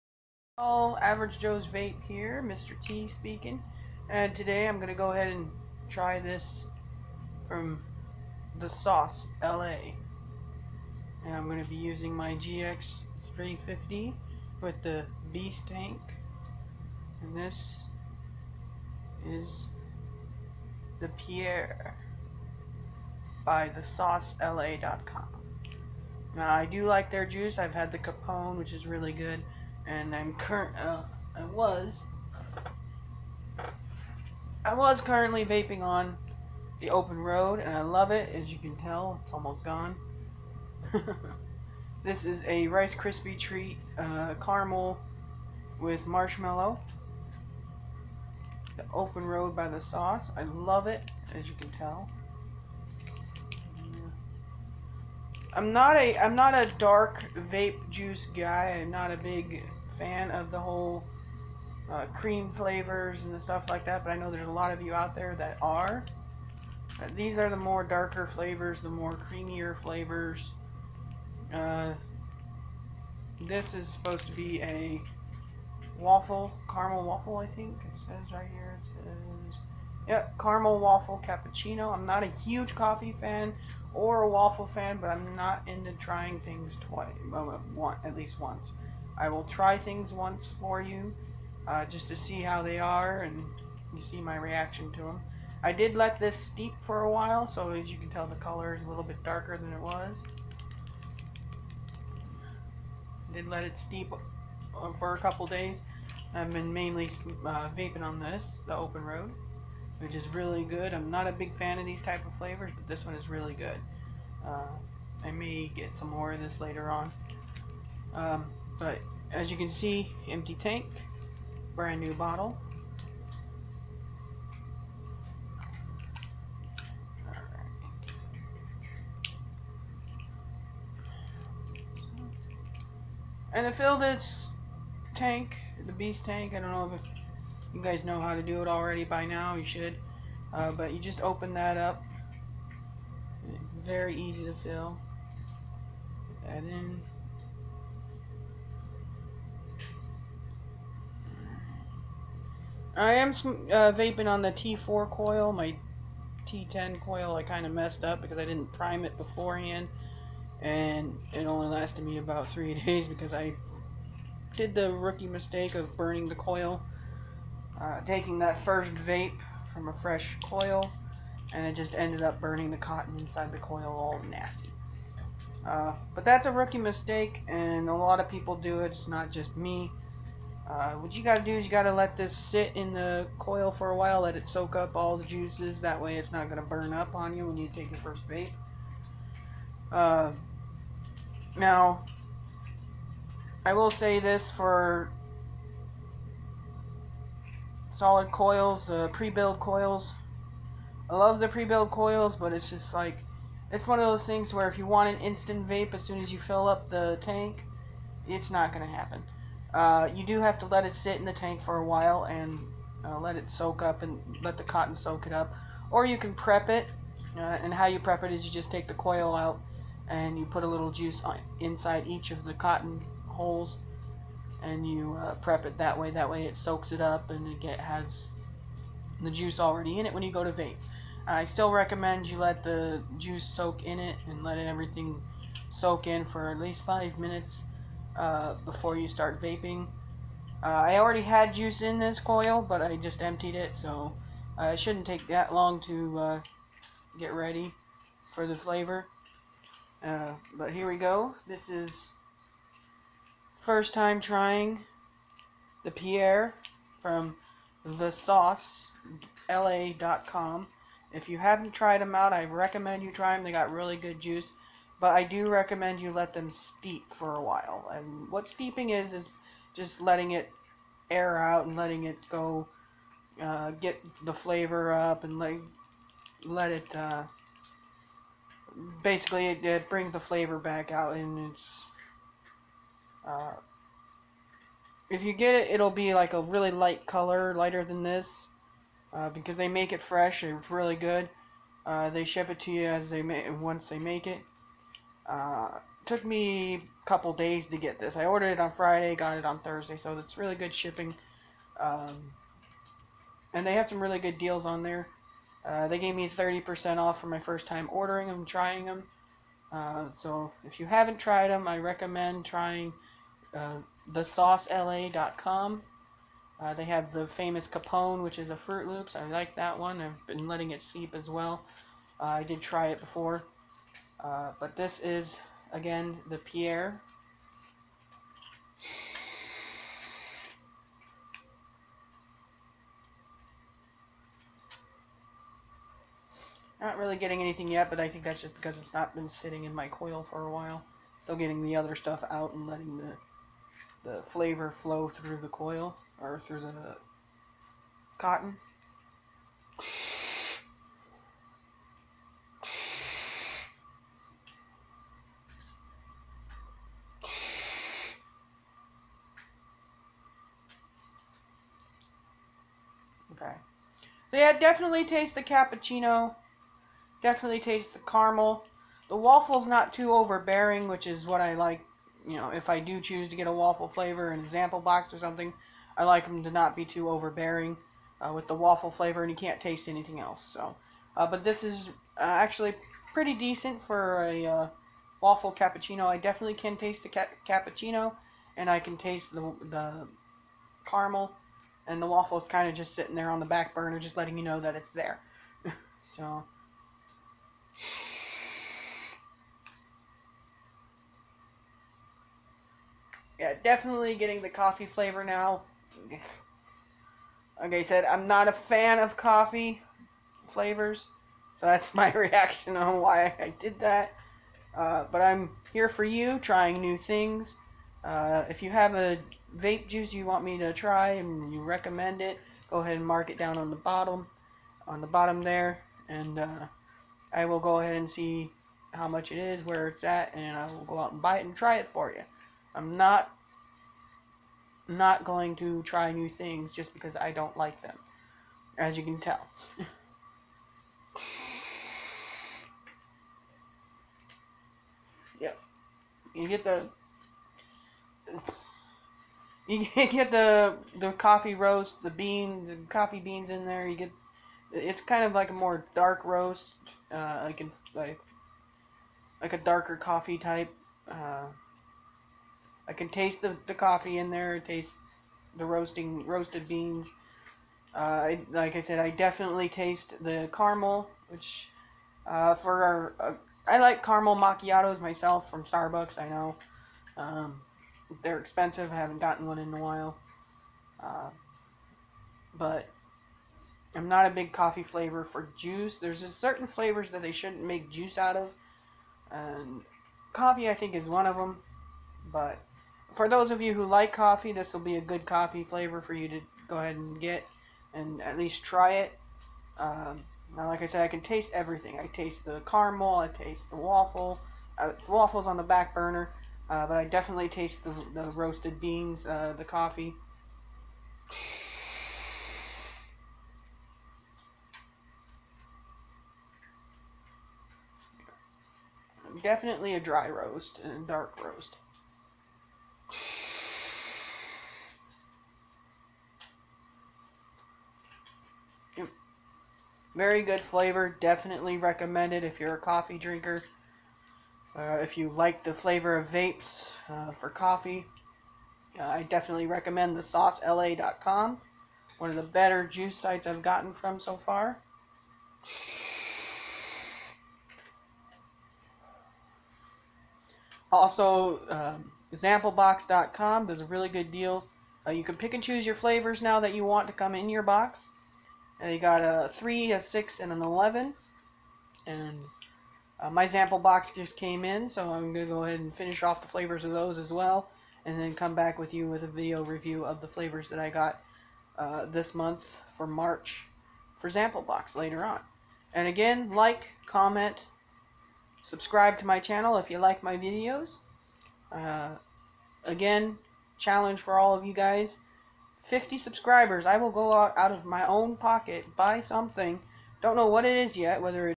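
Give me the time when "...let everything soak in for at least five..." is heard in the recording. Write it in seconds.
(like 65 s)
234 s.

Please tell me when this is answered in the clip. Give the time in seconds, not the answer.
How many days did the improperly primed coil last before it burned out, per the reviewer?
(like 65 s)
162 s.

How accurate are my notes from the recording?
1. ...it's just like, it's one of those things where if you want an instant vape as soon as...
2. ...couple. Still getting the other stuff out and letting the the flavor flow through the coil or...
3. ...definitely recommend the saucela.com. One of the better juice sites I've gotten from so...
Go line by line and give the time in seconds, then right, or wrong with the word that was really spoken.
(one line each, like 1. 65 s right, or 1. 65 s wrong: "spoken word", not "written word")
1. 202 s right
2. 340 s wrong: "while", not "couple"
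3. 539 s right.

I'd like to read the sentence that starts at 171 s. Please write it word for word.
And it just ended up burning the cotton inside the coil all nasty.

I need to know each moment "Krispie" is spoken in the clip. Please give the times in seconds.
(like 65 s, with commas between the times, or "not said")
42 s.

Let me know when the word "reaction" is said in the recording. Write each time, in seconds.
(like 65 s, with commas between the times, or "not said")
94 s, 412 s.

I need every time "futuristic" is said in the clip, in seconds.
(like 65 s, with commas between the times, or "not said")
not said.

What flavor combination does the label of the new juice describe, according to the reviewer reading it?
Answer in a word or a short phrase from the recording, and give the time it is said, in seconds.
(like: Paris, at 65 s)
Caramel waffle cappuccino, at 80 s.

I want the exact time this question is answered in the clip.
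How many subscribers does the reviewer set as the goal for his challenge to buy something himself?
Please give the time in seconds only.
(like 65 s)
585 s.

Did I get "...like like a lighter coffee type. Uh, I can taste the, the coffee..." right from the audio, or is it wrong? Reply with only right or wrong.
wrong.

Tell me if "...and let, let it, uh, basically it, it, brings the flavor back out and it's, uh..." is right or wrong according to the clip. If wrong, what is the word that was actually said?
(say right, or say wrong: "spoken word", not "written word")
right.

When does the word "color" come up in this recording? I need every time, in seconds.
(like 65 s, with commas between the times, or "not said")
98 s, 287 s.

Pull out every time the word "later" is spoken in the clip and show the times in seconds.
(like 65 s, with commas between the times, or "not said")
116 s, 574 s.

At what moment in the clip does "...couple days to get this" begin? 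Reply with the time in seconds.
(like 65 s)
297 s.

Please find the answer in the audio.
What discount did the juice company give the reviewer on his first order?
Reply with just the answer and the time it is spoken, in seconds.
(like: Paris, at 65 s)
30%, at 306 s.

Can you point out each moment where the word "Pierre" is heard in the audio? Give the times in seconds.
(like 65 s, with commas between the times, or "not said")
21 s, 255 s, 326 s.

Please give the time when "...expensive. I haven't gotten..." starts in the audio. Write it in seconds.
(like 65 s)
478 s.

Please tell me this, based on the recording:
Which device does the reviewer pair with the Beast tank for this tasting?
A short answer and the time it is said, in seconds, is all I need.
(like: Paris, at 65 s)
GX350, at 12 s.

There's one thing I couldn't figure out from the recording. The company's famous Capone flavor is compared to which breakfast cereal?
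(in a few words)
Fruit Loops.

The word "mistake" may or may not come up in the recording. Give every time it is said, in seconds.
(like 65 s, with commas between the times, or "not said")
165 s, 176 s.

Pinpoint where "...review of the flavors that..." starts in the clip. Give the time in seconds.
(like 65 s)
569 s.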